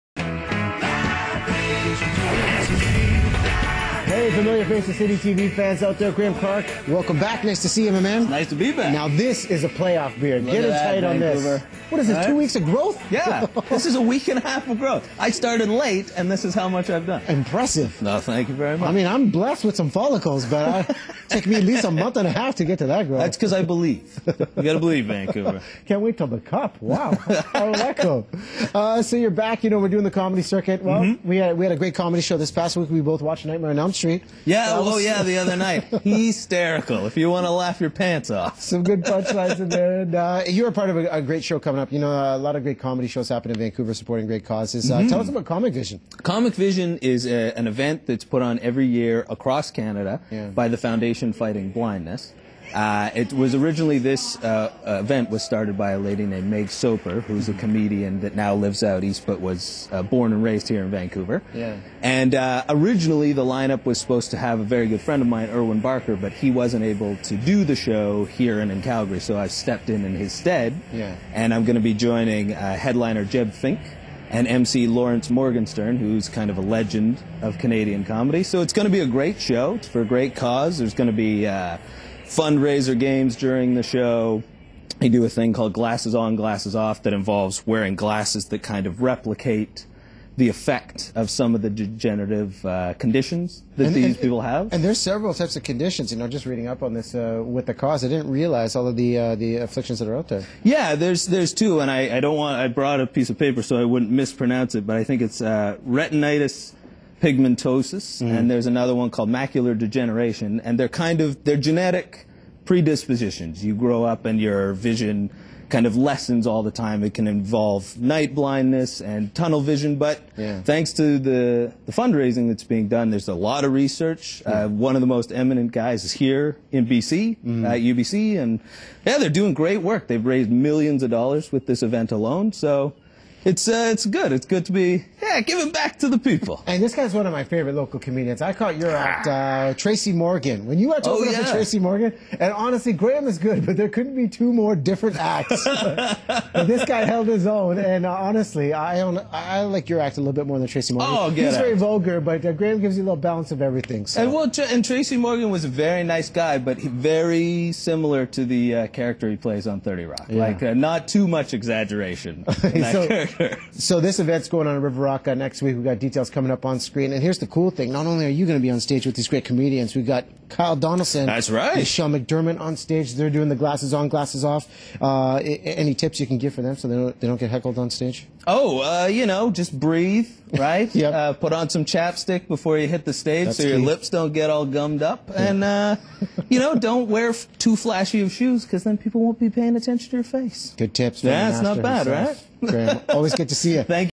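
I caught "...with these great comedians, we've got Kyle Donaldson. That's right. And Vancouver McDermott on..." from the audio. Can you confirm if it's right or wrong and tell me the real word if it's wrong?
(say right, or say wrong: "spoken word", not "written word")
wrong: "Sean", not "Vancouver".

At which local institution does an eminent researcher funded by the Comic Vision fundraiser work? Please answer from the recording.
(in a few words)
UBC.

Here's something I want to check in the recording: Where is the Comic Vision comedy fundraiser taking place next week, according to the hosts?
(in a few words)
River Rock.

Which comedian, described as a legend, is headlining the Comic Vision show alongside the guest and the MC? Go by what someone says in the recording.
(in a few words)
Jeb Fink.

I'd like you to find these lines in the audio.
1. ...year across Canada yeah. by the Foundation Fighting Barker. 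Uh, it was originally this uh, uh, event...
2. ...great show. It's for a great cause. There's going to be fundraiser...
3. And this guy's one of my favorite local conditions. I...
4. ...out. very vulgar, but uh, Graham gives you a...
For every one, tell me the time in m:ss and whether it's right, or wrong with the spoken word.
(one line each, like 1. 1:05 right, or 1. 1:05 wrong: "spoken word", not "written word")
1. 0:48 wrong: "Blindness", not "Barker"
2. 1:19 right
3. 2:16 wrong: "comedians", not "conditions"
4. 2:31 right.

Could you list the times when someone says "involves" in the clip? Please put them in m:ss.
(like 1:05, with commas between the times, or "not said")
1:27, 1:57.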